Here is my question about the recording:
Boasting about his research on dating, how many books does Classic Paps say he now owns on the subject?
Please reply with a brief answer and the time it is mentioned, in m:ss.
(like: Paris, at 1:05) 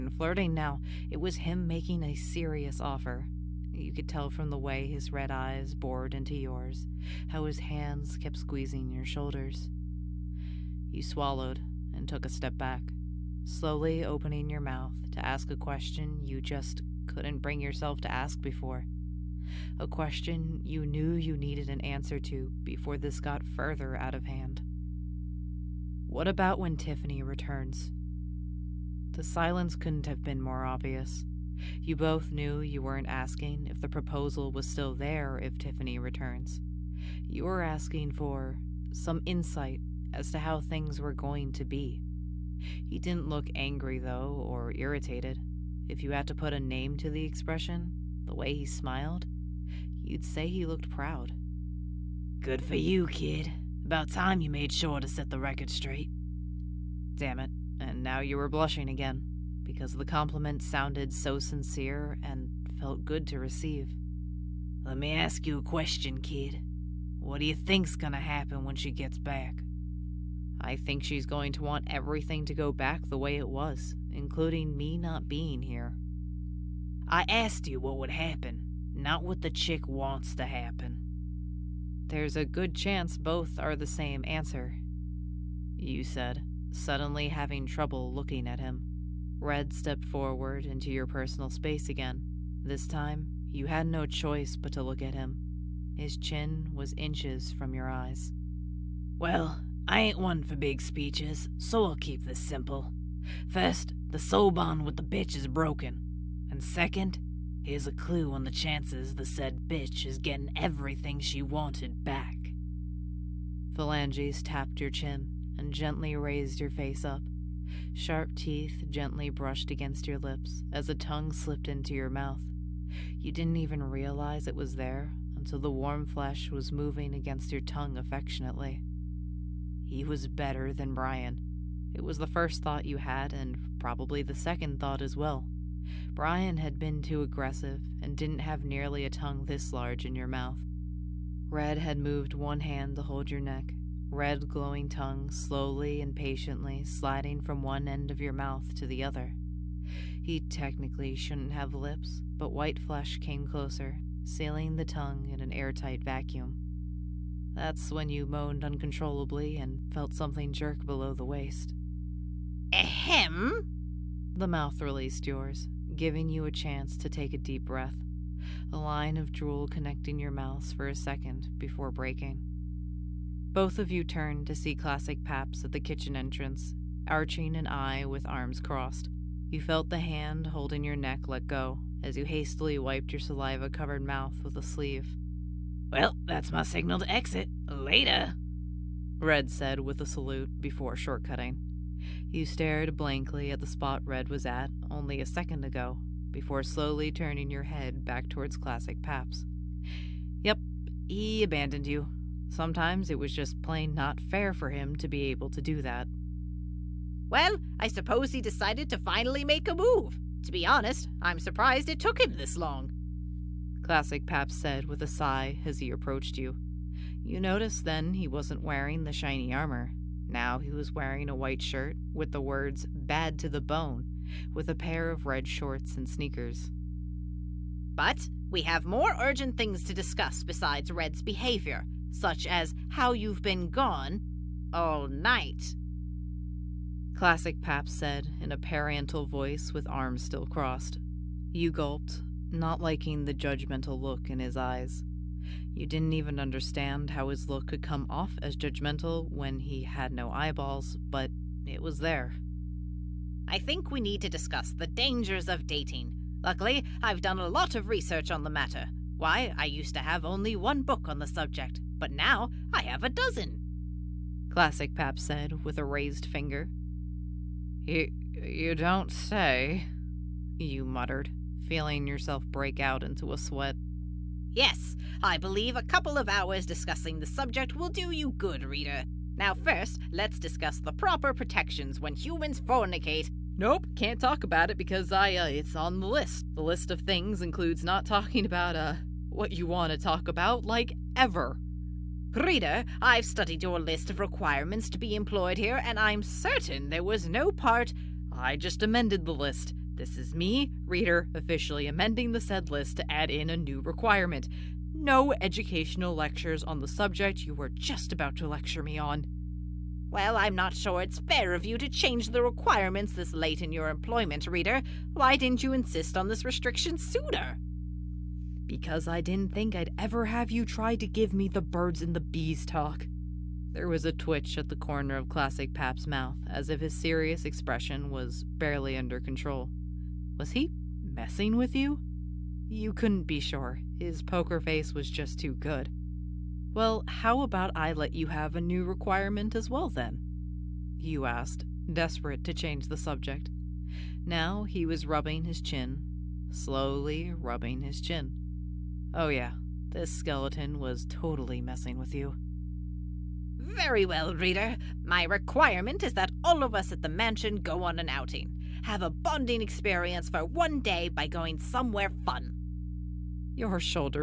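12, at 4:23.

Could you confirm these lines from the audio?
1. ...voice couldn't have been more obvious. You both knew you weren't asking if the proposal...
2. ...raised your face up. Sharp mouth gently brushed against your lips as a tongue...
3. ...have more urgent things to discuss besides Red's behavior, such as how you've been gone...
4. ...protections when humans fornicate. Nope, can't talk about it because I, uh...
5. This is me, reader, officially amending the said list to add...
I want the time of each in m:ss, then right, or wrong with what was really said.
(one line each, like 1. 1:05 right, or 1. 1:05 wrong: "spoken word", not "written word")
1. 0:29 wrong: "silence", not "voice"
2. 1:56 wrong: "teeth", not "mouth"
3. 3:48 right
4. 4:41 right
5. 4:59 right.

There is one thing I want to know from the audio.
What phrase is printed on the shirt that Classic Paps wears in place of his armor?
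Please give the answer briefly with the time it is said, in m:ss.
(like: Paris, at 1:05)
bad to the bone, at 3:42.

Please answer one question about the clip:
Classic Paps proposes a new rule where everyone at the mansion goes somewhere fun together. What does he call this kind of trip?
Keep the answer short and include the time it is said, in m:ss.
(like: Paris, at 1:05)
an outing, at 5:57.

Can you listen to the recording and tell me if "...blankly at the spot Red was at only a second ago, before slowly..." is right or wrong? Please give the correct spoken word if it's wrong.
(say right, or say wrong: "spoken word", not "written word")
right.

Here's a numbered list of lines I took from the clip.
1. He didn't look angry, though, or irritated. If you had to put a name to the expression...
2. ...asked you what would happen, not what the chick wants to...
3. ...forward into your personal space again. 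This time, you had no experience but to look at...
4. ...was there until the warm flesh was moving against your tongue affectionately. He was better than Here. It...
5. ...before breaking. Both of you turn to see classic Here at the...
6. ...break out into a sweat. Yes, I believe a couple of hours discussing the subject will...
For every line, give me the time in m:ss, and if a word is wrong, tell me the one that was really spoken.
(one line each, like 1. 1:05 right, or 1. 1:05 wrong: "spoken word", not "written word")
1. 0:42 right
2. 1:17 right
3. 1:30 wrong: "choice", not "experience"
4. 2:04 wrong: "Brian", not "Here"
5. 2:51 wrong: "Paps", not "Here"
6. 4:32 right.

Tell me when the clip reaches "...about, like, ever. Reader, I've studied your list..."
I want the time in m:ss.
4:50.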